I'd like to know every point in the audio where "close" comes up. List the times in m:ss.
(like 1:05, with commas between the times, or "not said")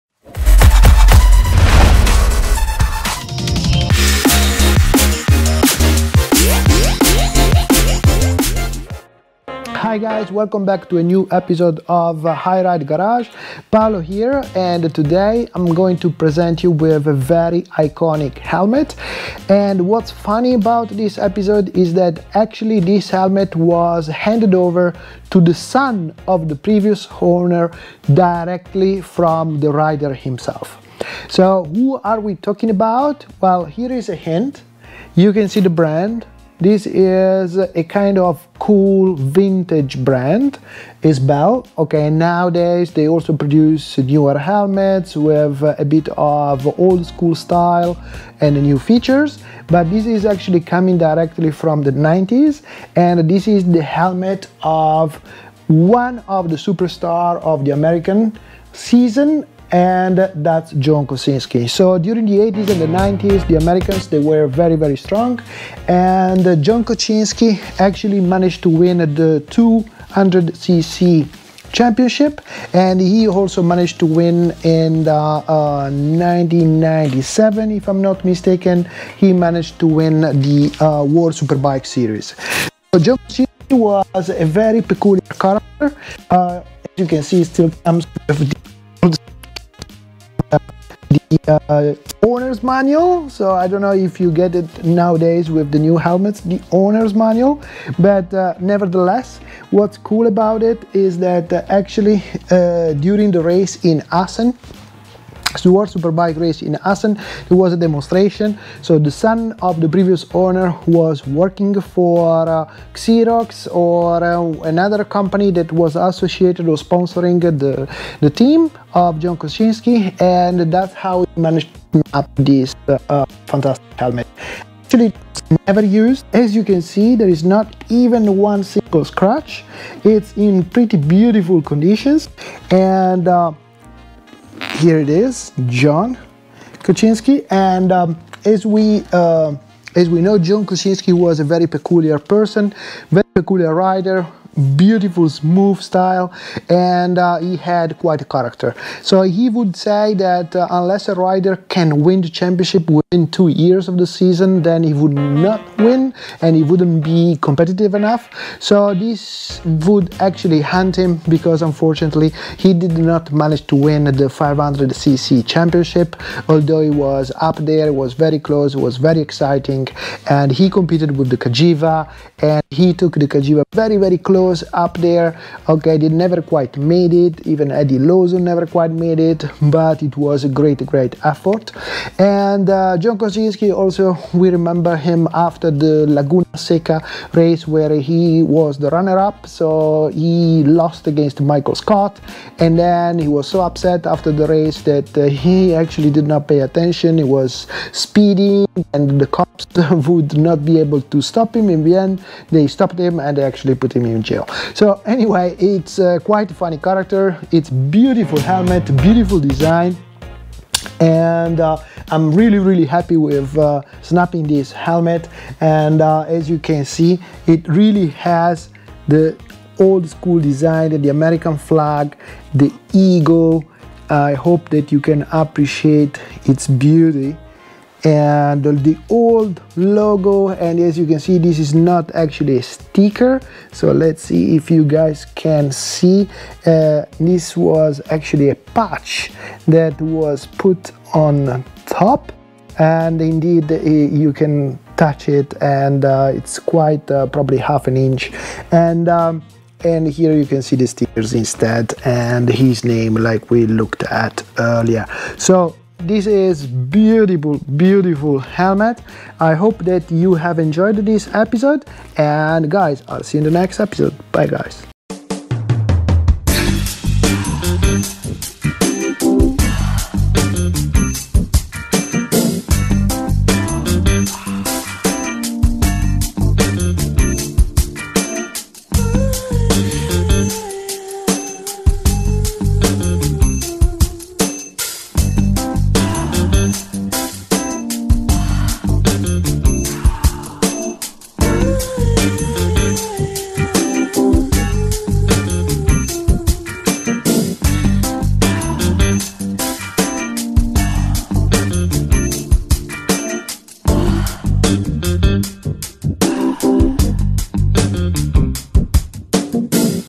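2:48, 2:54.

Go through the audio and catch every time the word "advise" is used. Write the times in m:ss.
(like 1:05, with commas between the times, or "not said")
not said.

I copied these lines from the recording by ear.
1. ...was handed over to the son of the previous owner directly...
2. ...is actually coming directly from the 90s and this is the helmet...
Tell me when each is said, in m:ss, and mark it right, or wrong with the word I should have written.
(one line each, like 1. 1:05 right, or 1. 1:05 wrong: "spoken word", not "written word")
1. 0:23 right
2. 0:50 right.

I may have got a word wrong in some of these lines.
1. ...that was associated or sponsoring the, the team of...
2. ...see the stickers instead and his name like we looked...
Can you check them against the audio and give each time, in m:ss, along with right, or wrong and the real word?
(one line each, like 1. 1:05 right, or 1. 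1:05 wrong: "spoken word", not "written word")
1. 1:55 right
2. 4:10 right.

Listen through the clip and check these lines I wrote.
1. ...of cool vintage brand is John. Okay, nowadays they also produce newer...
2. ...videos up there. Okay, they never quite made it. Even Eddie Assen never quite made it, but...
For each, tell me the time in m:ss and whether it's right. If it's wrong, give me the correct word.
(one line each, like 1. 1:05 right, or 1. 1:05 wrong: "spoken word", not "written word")
1. 0:38 wrong: "Bell", not "John"
2. 2:54 wrong: "Lawson", not "Assen".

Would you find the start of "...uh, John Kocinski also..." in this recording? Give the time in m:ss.
3:02.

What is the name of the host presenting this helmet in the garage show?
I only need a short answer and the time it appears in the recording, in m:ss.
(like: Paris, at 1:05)
Paolo, at 0:13.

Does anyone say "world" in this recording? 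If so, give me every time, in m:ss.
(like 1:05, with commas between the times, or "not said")
1:21, 1:45.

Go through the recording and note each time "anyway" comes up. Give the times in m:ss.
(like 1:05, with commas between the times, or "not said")
3:25.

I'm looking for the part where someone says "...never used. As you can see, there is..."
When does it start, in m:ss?
2:05.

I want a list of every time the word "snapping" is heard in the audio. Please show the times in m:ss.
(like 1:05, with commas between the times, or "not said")
3:34.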